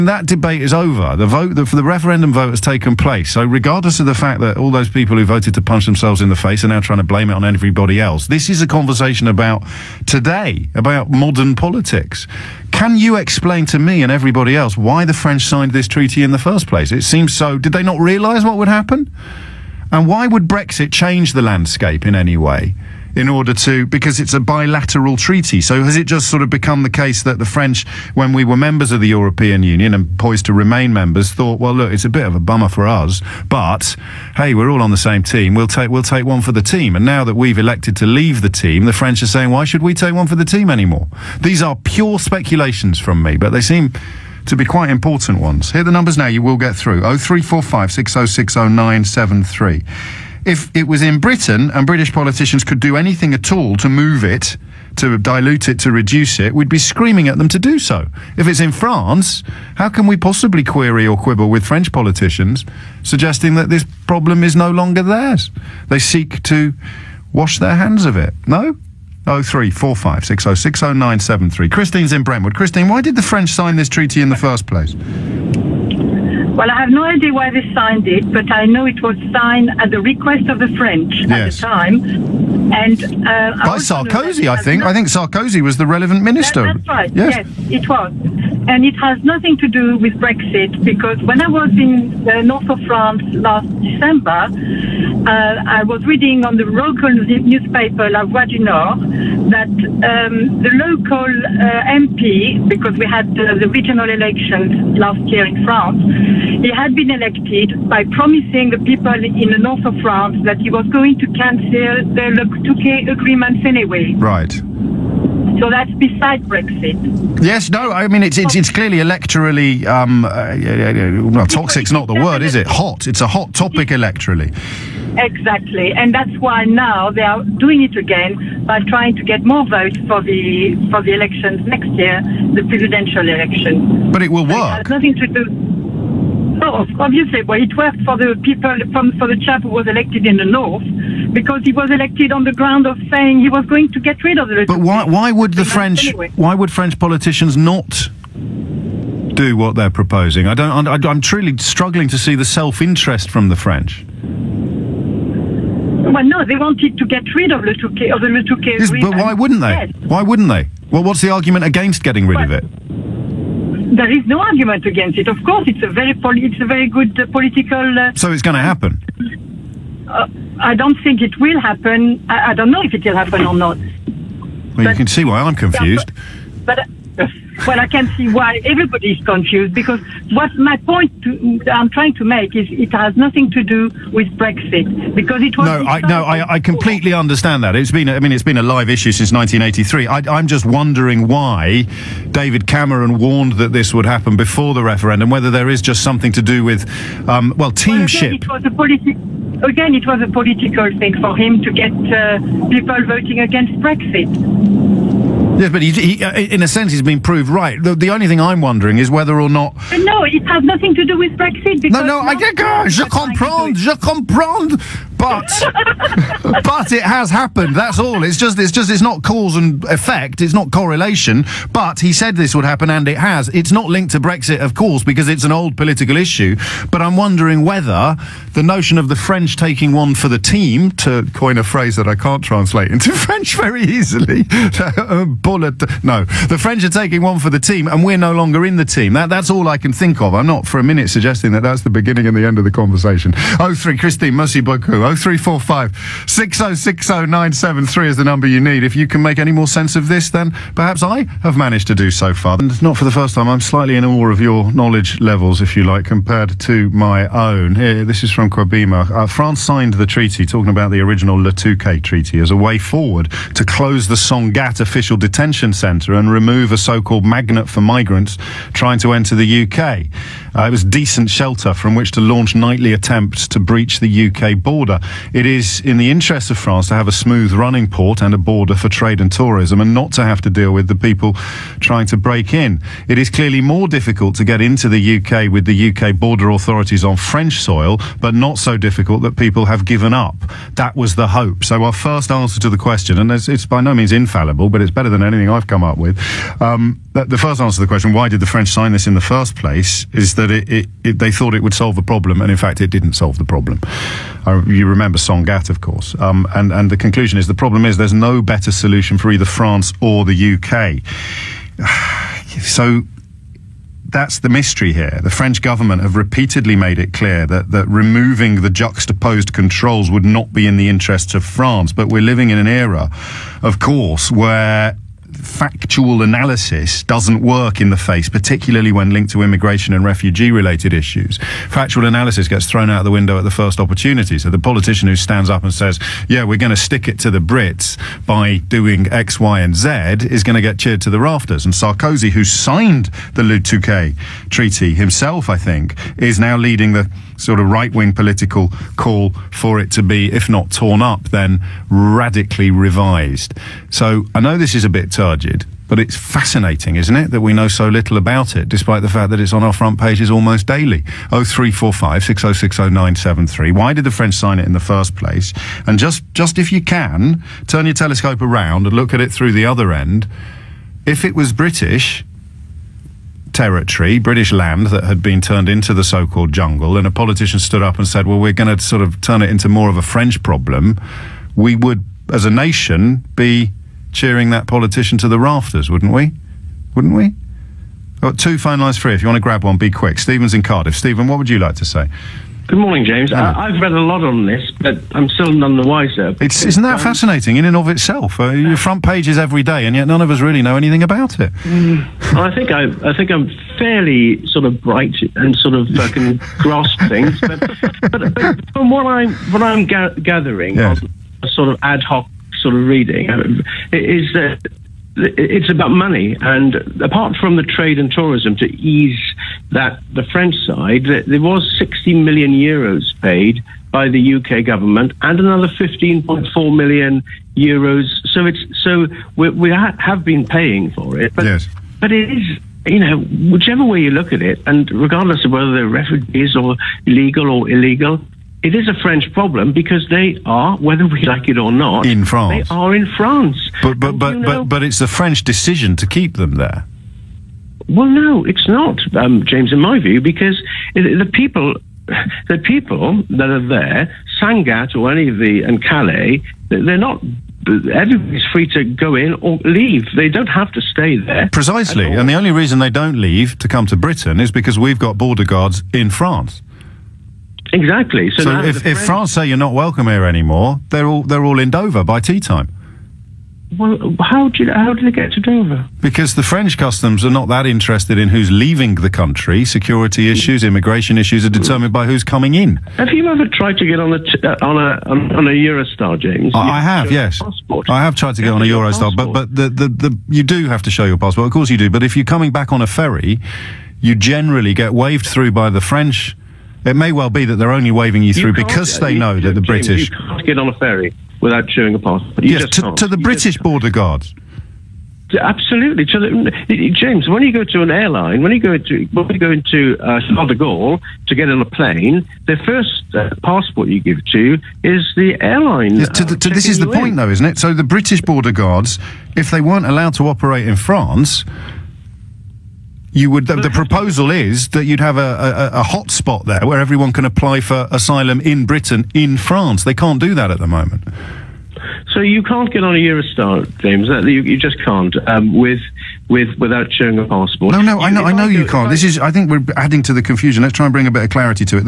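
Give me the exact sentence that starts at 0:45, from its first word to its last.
Here are the numbers now you will get through.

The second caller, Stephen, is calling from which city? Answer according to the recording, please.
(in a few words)
Cardiff.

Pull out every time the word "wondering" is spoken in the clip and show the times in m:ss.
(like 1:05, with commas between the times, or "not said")
3:10, 3:28, 3:47.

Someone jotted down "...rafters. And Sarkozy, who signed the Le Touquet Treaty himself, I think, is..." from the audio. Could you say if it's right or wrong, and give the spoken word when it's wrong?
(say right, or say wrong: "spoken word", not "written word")
right.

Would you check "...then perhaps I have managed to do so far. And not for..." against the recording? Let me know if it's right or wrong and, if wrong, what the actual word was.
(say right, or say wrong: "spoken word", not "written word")
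right.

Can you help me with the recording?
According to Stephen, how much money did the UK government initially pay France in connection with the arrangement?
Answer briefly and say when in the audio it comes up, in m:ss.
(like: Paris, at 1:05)
60 million euros, at 7:01.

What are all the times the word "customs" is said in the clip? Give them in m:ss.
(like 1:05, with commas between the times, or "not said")
7:56.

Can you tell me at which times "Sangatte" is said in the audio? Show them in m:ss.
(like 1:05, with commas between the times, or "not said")
4:24, 5:05, 7:34.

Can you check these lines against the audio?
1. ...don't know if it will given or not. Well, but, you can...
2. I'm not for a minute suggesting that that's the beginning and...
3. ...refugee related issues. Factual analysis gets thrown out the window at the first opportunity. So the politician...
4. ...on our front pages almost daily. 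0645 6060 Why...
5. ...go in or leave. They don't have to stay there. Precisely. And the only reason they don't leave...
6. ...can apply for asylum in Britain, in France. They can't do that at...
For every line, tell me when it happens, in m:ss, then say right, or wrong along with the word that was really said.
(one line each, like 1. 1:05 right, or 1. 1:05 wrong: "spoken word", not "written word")
1. 2:52 wrong: "happen", not "given"
2. 4:00 right
3. 5:30 right
4. 5:59 wrong: "0345", not "0645"
5. 7:38 right
6. 8:47 right.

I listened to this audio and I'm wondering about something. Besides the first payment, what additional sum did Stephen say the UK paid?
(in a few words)
15.4 million euros.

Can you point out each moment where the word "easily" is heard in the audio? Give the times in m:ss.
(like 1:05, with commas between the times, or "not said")
3:53.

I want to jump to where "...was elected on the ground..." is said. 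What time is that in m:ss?
2:21.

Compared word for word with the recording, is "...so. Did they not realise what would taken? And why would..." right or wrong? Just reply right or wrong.
wrong.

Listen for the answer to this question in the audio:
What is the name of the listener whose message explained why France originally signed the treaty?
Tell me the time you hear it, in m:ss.
4:18.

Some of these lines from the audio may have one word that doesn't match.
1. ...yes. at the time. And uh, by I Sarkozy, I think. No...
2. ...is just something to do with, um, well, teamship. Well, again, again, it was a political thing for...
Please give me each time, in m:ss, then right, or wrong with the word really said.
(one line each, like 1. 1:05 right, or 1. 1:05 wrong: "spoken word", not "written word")
1. 1:21 right
2. 3:15 right.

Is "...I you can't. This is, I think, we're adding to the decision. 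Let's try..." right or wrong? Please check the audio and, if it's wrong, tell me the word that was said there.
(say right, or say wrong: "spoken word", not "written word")
wrong: "confusion", not "decision".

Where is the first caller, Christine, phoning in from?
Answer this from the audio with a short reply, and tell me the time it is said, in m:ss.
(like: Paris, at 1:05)
Brentwood, at 1:12.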